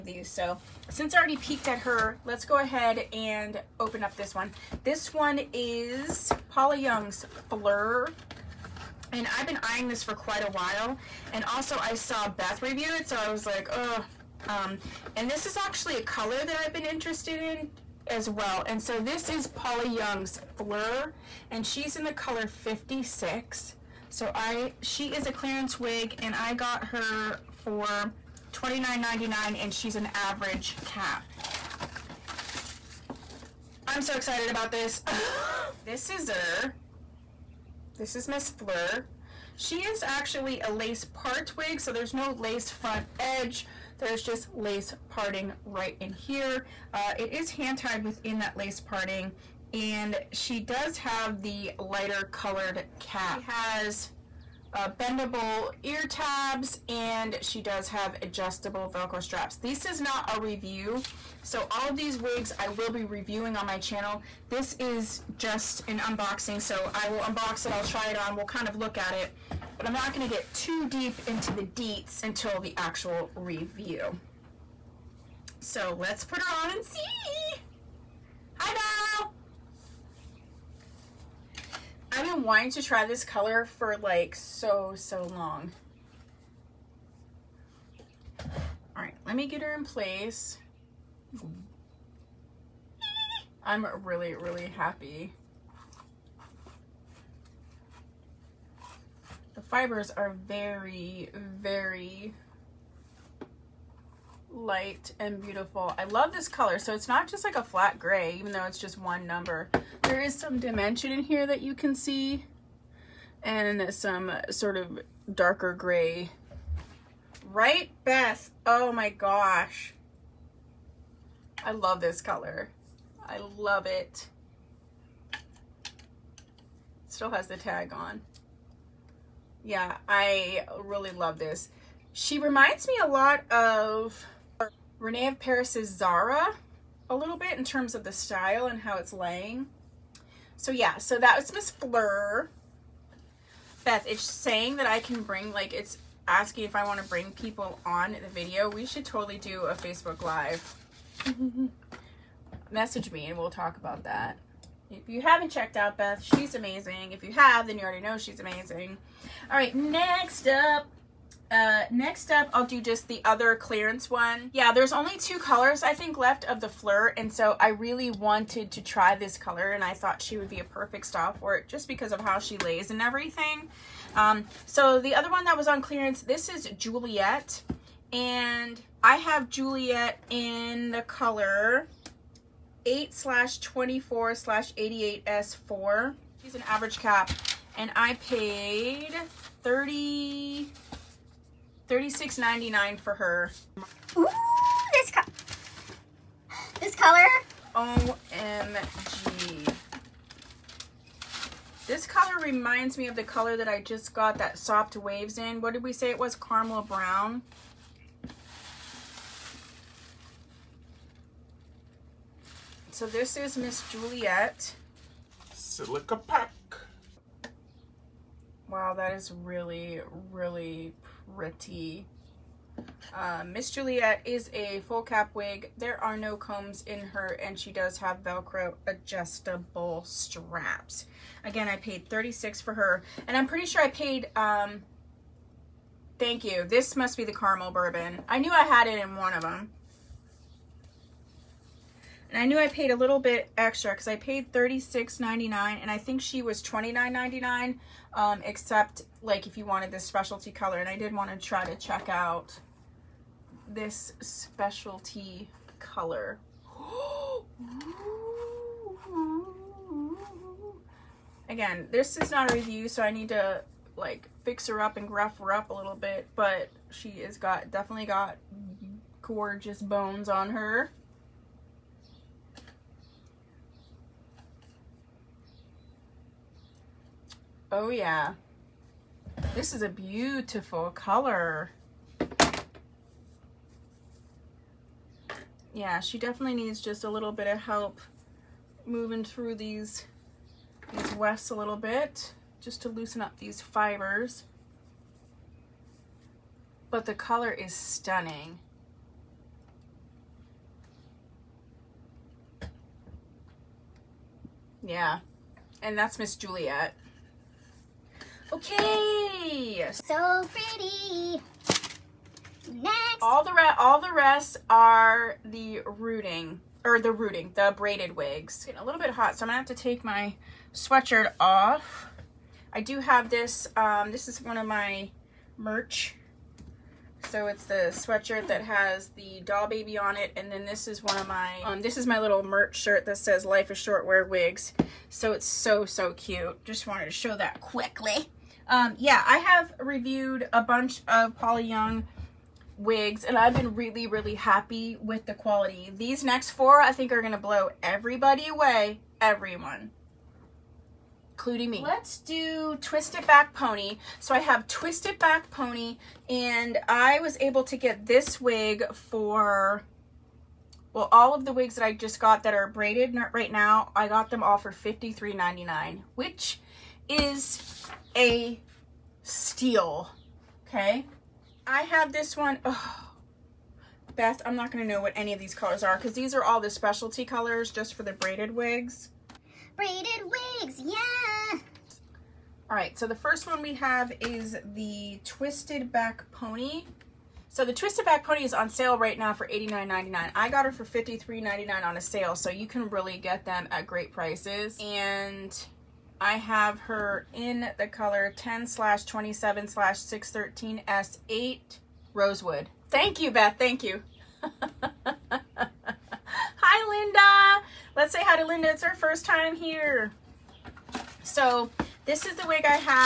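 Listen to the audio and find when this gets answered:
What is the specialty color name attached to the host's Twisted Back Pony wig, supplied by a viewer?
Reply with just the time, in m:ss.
6:42.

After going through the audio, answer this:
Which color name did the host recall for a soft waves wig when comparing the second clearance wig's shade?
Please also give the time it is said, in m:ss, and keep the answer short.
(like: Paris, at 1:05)
Caramel brown, at 3:26.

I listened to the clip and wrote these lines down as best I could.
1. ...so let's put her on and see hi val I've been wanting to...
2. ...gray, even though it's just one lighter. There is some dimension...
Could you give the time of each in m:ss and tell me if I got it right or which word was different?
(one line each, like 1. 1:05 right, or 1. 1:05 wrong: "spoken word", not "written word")
1. 1:15 right
2. 1:47 wrong: "number", not "lighter".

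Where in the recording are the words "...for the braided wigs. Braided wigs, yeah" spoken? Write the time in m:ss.
6:17.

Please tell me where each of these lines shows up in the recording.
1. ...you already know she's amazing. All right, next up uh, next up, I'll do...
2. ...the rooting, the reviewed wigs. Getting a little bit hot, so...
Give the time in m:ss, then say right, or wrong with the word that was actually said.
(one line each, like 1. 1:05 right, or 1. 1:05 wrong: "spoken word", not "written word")
1. 2:37 right
2. 5:16 wrong: "braided", not "reviewed".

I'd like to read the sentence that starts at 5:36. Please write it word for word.
Just wanted to show that quickly.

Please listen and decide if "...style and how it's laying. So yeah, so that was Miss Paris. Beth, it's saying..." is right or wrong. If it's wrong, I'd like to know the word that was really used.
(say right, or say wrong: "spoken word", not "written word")
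wrong: "Fleur", not "Paris".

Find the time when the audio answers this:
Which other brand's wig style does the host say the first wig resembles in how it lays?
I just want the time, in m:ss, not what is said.
2:15.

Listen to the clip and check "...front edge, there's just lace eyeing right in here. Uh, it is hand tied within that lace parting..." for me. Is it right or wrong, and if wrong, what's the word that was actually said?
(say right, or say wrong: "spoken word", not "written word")
wrong: "parting", not "eyeing".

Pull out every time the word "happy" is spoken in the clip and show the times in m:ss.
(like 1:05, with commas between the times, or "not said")
1:34, 5:44.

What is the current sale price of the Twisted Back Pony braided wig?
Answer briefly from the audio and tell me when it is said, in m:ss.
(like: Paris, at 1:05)
$89.99, at 6:29.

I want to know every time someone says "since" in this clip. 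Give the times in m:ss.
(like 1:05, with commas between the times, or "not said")
0:00.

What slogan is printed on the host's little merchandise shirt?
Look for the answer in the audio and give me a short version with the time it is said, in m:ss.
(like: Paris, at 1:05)
Life is Short, Wear Wigs, at 5:33.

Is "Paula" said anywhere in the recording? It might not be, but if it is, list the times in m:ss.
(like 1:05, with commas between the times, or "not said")
0:06, 0:19, 5:41.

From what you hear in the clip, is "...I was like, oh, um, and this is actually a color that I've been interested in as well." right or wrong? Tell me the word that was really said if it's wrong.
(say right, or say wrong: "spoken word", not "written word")
right.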